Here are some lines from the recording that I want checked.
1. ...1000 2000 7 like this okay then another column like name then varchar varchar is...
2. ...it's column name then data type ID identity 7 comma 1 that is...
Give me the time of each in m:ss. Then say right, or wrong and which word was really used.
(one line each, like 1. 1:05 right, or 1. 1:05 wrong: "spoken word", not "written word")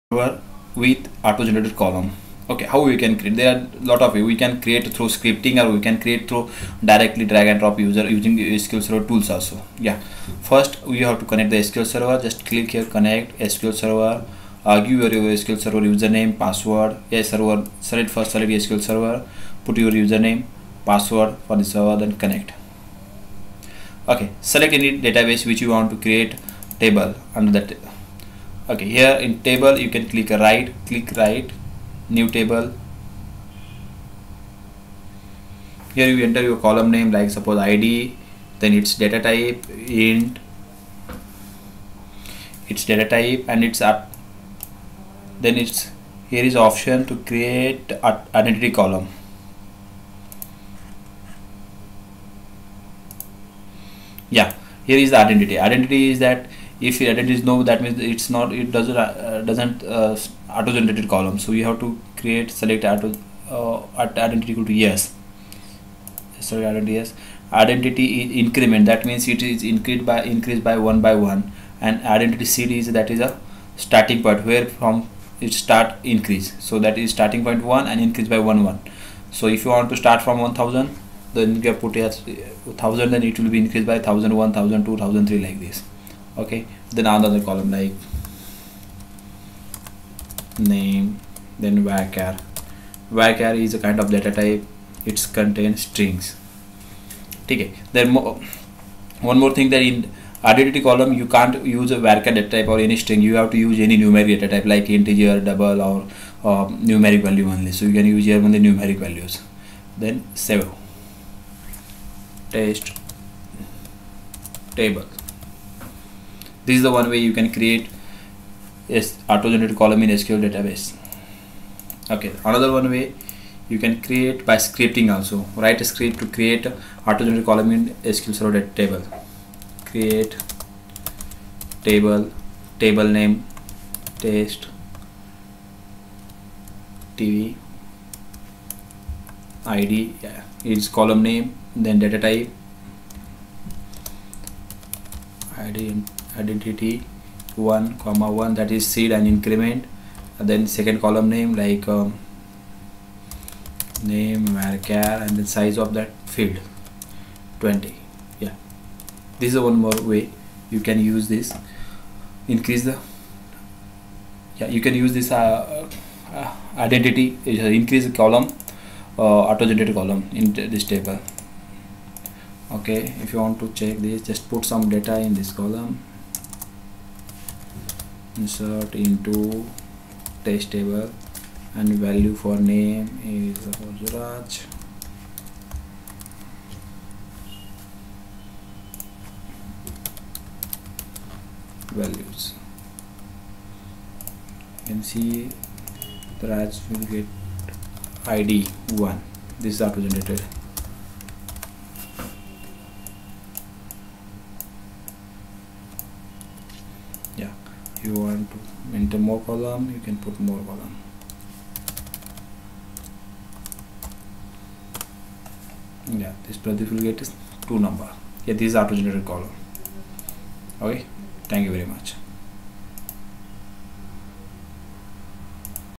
1. 1:24 wrong: "3", not "7"
2. 2:20 wrong: "1", not "7".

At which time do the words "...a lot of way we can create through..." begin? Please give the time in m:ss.
0:03.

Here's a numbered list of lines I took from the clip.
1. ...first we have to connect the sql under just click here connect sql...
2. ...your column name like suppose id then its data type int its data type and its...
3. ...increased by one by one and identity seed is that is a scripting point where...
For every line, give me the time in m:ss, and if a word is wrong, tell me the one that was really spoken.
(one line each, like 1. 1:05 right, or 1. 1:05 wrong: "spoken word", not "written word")
1. 0:10 wrong: "server", not "under"
2. 0:36 right
3. 1:10 wrong: "starting", not "scripting".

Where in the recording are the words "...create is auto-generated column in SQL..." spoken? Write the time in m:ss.
1:57.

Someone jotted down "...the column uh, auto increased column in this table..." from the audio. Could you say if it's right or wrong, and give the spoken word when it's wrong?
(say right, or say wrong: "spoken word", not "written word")
wrong: "generated", not "increased".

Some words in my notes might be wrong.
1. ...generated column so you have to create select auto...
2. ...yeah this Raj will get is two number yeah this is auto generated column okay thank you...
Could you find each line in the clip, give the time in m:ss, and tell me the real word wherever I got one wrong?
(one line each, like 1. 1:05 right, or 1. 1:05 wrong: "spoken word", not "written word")
1. 1:00 right
2. 3:36 wrong: "Pradeep", not "Raj".